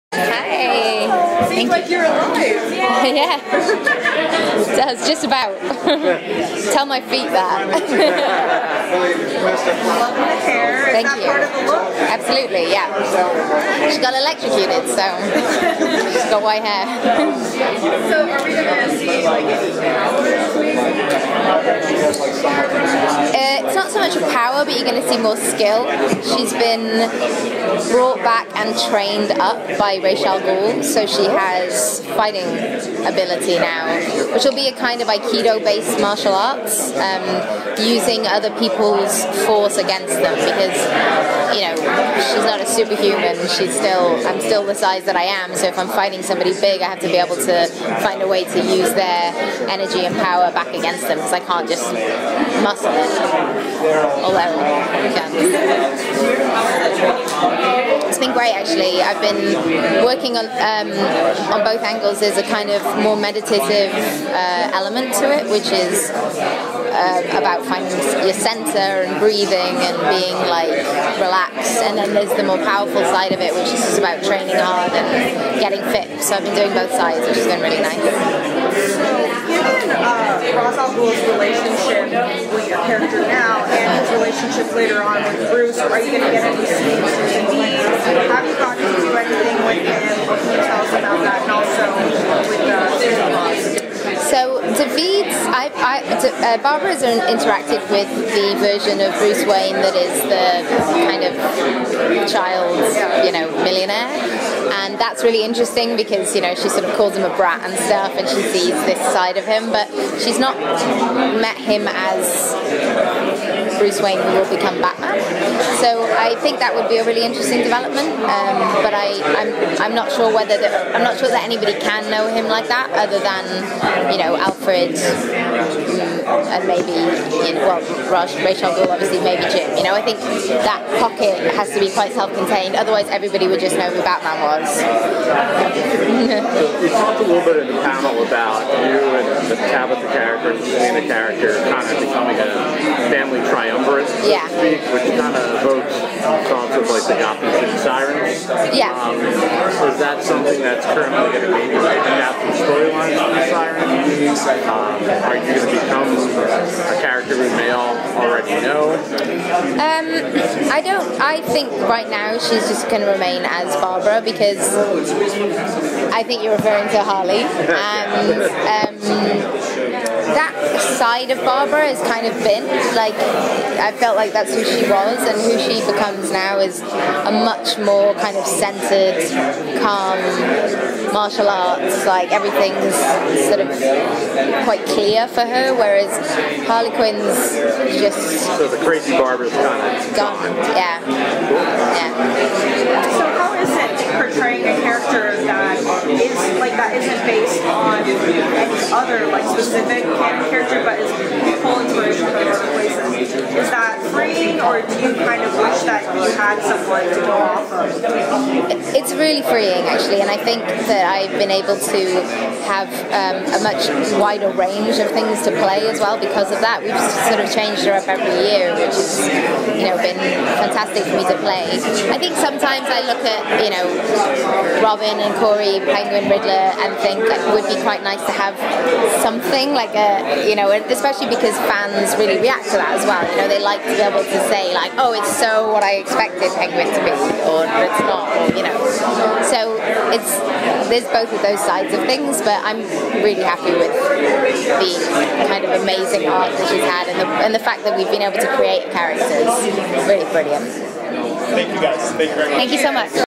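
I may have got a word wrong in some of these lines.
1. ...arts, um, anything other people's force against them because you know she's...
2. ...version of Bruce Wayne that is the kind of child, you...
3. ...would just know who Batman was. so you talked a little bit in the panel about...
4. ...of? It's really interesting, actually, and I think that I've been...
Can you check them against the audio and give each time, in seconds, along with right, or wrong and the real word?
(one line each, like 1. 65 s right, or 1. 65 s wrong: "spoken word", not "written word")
1. 36 s wrong: "using", not "anything"
2. 98 s right
3. 133 s right
4. 207 s wrong: "freeing", not "interesting".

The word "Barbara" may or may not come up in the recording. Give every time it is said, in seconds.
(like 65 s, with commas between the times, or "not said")
96 s, 163 s, 171 s, 189 s.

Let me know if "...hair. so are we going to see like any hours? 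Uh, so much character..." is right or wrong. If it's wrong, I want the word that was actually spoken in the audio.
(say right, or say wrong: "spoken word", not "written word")
wrong: "power", not "character".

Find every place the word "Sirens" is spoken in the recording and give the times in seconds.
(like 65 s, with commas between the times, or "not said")
147 s, 153 s.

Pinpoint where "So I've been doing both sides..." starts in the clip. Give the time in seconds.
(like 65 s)
76 s.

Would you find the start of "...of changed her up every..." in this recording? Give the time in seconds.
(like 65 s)
217 s.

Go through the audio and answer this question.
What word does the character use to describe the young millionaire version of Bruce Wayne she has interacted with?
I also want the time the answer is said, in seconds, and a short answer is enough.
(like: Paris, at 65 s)
brat, at 107 s.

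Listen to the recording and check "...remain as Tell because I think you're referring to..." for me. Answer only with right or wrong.
wrong.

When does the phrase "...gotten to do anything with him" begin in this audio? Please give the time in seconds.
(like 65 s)
88 s.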